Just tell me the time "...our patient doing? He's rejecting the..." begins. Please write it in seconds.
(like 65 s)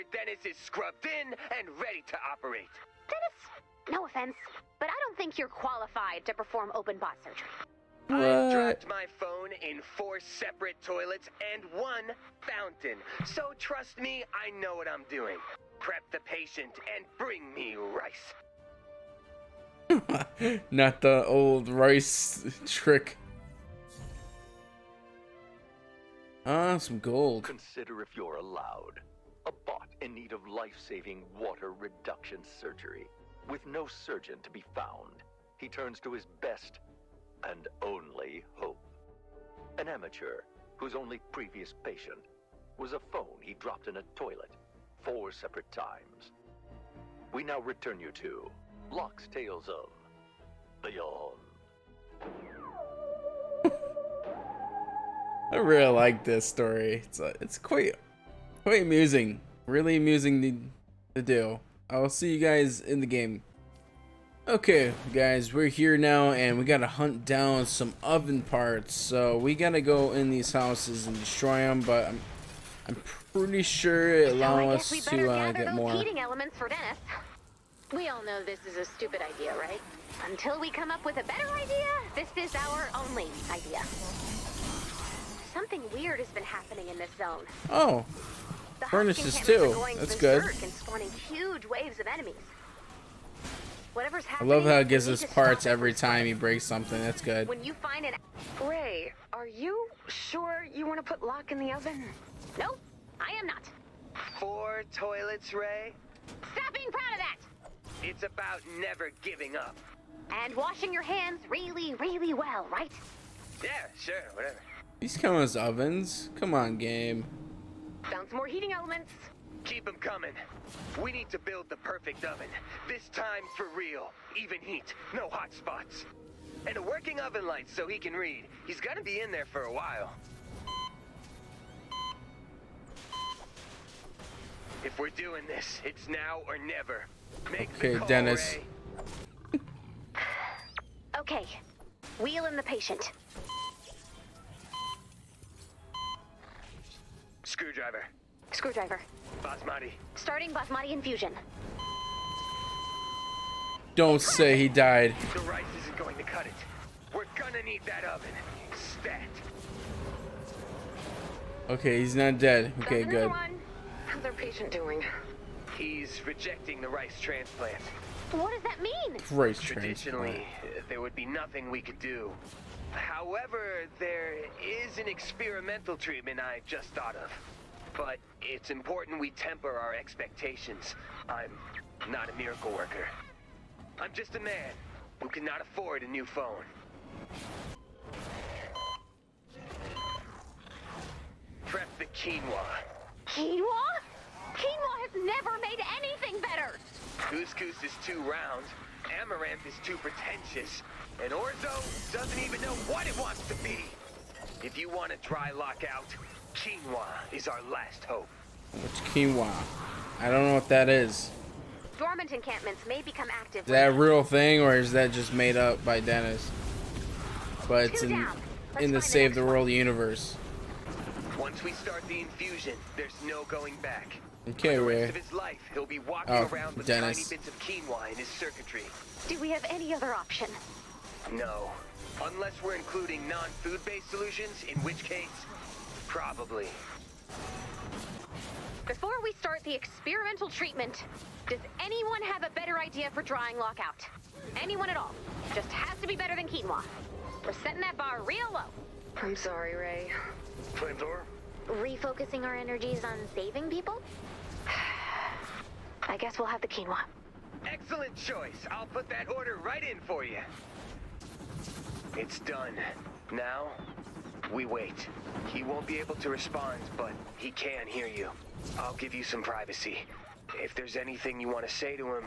164 s.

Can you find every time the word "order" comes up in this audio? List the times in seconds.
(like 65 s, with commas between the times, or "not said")
259 s.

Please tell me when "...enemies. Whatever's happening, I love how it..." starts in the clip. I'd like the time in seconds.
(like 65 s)
92 s.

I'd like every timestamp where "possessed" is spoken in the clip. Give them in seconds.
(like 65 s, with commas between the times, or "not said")
not said.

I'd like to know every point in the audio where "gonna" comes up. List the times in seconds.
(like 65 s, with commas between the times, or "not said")
128 s, 157 s.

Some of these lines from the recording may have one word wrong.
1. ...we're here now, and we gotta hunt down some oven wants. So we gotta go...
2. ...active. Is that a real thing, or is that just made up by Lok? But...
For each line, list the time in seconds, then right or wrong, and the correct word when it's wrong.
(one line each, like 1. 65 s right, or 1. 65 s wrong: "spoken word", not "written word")
1. 65 s wrong: "parts", not "wants"
2. 213 s wrong: "Dennis", not "Lok".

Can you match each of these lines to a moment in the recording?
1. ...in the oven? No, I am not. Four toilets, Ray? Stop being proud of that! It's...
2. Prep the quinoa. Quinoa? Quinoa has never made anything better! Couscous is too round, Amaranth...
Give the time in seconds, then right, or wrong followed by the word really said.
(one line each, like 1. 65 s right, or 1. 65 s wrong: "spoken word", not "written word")
1. 101 s right
2. 191 s right.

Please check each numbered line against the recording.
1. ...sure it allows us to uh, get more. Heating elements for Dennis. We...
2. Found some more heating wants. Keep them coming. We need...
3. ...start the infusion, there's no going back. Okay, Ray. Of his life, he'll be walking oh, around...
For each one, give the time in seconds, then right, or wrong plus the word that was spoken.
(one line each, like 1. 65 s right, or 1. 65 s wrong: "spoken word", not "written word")
1. 73 s right
2. 118 s wrong: "elements", not "wants"
3. 221 s right.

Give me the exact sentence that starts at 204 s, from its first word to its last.
If you want a dry lockout, quinoa is our last hope.